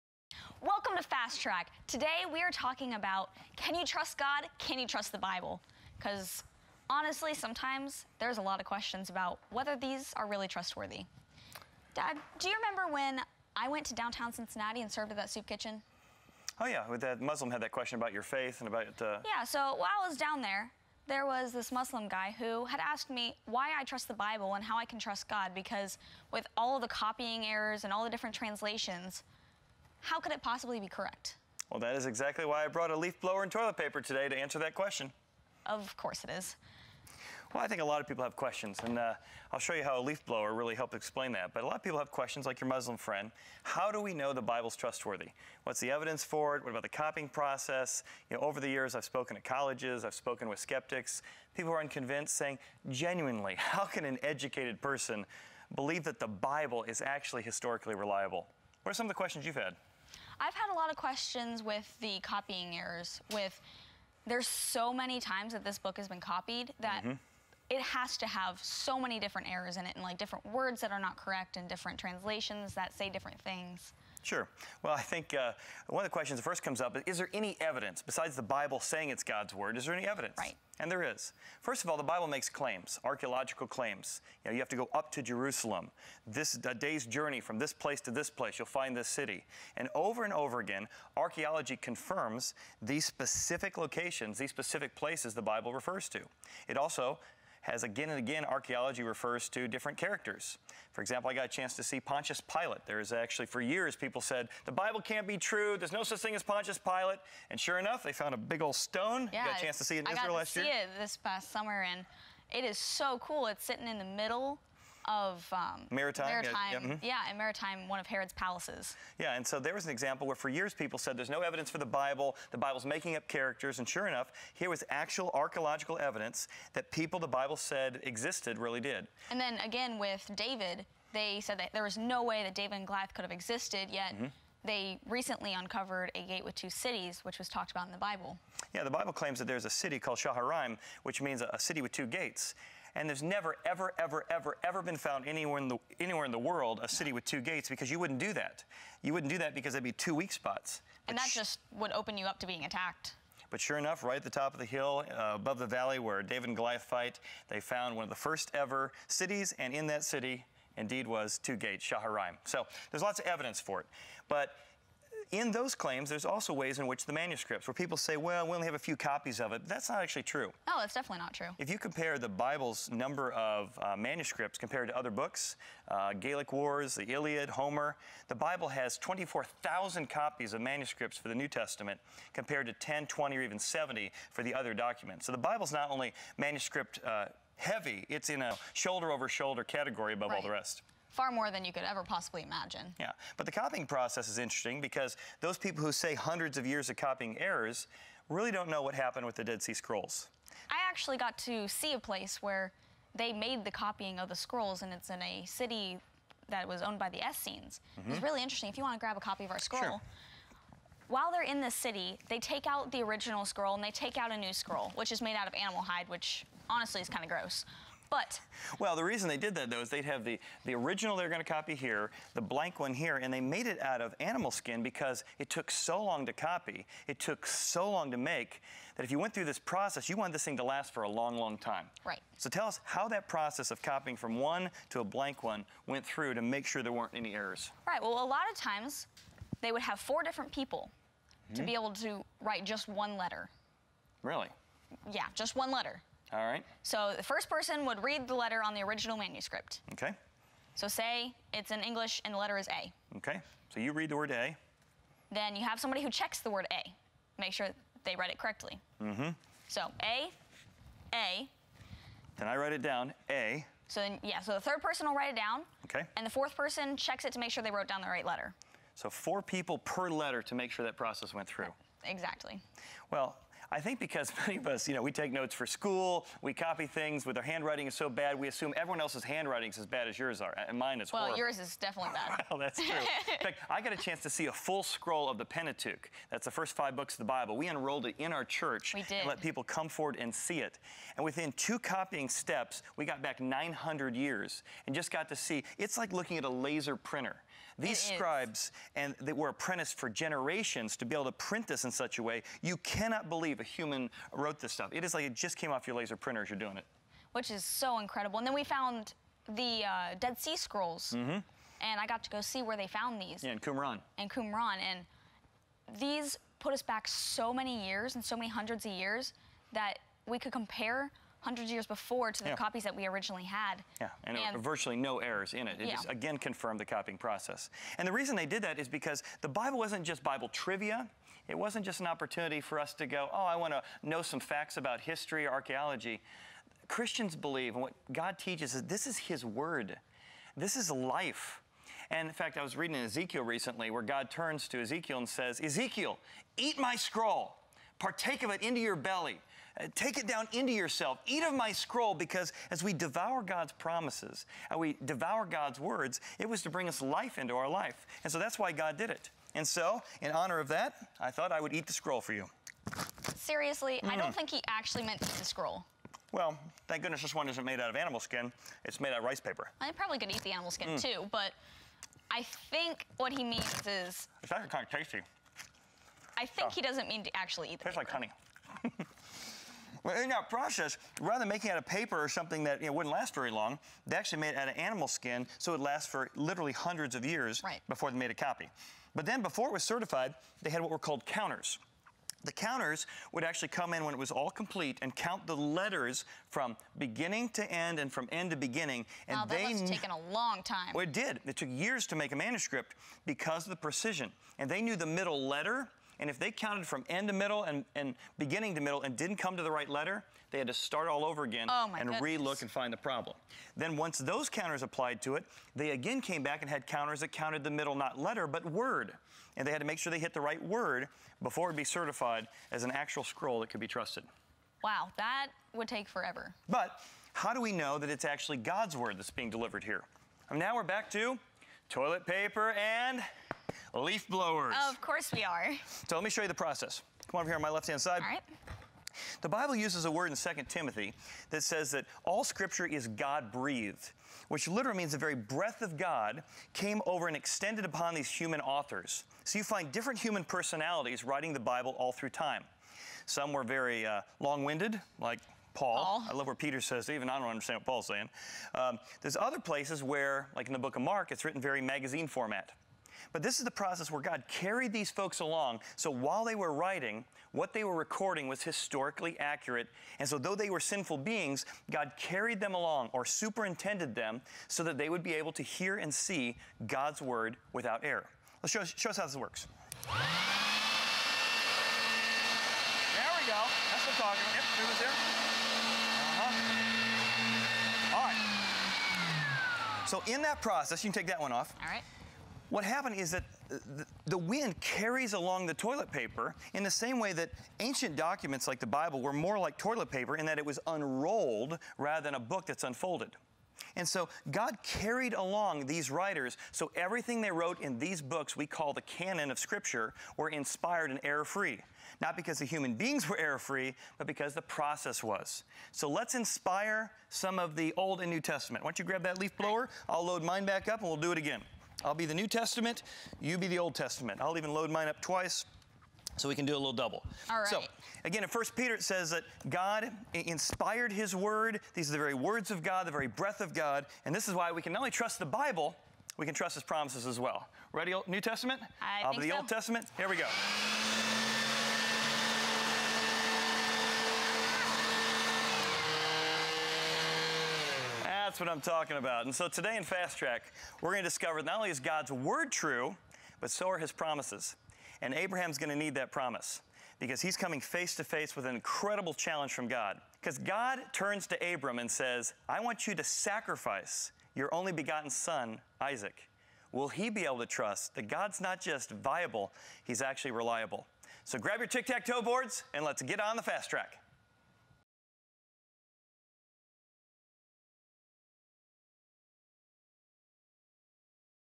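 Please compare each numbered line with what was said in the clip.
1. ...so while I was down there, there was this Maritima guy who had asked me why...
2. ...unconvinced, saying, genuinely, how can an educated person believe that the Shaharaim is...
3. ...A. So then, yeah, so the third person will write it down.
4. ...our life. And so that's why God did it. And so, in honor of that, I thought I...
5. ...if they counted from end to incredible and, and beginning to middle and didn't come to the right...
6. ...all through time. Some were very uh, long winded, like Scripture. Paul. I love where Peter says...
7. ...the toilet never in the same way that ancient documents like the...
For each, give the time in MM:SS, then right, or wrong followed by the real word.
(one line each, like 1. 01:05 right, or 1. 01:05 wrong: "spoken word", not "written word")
1. 00:19 wrong: "Muslim", not "Maritima"
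2. 00:51 wrong: "Bible", not "Shaharaim"
3. 04:23 right
4. 05:57 right
5. 06:46 wrong: "middle", not "incredible"
6. 07:31 wrong: "Paul", not "Scripture"
7. 08:15 wrong: "paper", not "never".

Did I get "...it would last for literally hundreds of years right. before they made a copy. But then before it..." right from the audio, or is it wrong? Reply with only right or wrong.
right.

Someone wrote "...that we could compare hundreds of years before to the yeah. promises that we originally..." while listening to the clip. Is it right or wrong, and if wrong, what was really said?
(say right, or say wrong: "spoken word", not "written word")
wrong: "copies", not "promises".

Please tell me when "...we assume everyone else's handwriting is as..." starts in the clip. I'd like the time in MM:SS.
04:38.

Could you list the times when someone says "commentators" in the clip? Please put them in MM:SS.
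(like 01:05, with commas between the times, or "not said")
not said.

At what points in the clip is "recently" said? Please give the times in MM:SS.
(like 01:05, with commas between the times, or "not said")
02:15, 05:43.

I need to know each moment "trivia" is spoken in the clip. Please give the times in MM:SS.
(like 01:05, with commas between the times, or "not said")
05:30.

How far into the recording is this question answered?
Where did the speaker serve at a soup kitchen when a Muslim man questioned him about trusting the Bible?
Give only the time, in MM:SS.
00:13.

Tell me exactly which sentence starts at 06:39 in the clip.
And wow, that they must have taken a long time.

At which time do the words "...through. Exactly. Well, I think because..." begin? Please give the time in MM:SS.
04:31.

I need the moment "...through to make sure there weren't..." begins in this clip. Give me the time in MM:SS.
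03:56.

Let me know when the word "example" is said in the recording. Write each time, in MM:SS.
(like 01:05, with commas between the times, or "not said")
01:41, 01:59.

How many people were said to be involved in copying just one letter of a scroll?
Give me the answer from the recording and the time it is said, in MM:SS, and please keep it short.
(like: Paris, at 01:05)
4, at 04:00.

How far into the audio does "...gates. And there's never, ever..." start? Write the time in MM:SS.
02:22.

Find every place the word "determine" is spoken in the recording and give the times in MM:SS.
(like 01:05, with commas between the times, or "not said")
not said.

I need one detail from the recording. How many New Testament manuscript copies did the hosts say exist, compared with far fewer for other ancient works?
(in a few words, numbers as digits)
24,000.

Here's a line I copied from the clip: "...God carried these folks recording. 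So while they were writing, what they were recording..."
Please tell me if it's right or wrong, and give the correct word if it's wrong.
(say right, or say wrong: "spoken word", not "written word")
wrong: "along", not "recording".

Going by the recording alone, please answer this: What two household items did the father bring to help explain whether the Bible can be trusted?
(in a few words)
leaf blower and toilet paper.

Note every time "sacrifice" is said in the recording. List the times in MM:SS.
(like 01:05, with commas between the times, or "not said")
09:23.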